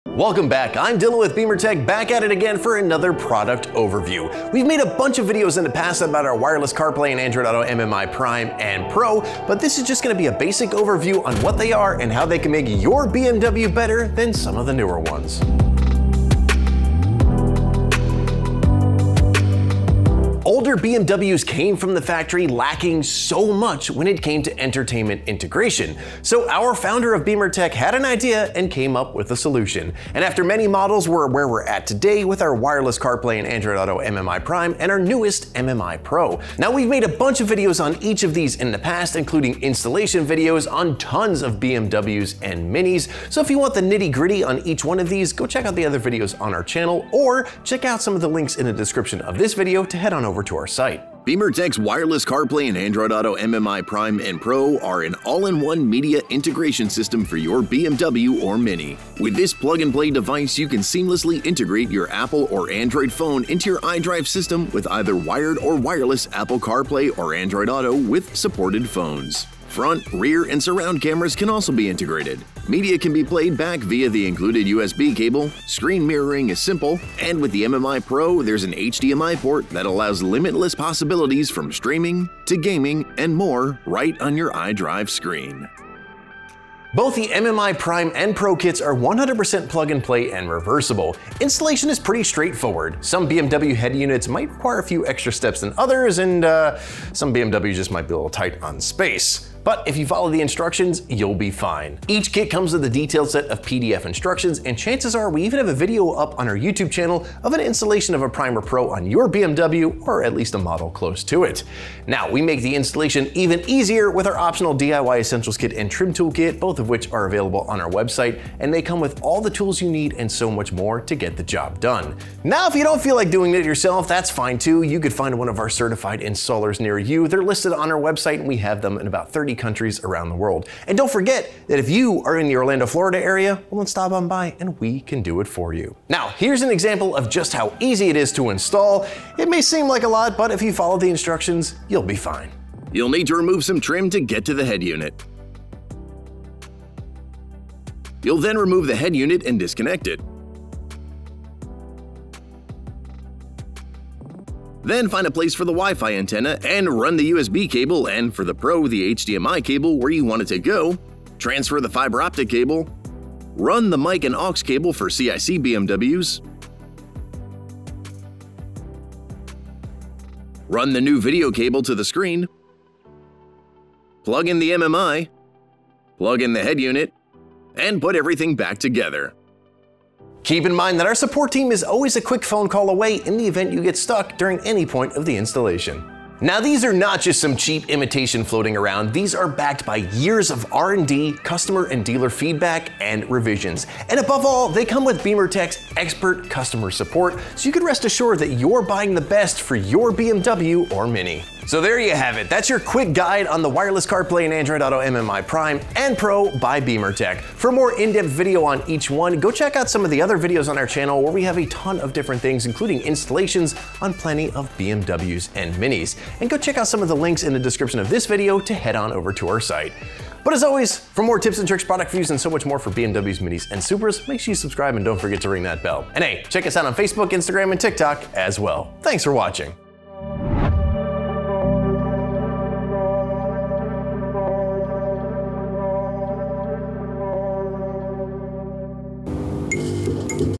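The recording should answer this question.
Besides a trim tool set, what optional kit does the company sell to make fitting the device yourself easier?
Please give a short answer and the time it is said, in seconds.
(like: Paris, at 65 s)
DIY Essentials Kit, at 114 s.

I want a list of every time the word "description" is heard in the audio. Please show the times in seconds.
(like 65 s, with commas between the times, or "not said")
48 s, 217 s.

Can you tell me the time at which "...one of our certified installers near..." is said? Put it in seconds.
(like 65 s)
125 s.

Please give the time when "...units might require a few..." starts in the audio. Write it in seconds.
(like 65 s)
93 s.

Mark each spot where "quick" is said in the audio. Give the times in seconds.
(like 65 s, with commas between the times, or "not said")
182 s, 202 s.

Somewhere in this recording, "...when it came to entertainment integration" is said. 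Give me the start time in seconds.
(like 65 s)
23 s.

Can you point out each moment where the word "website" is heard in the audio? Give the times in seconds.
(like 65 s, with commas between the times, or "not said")
117 s, 128 s.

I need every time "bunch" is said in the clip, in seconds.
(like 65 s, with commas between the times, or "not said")
4 s, 37 s.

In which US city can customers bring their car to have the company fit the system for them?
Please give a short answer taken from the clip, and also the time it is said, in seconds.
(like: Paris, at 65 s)
Orlando, Florida, at 132 s.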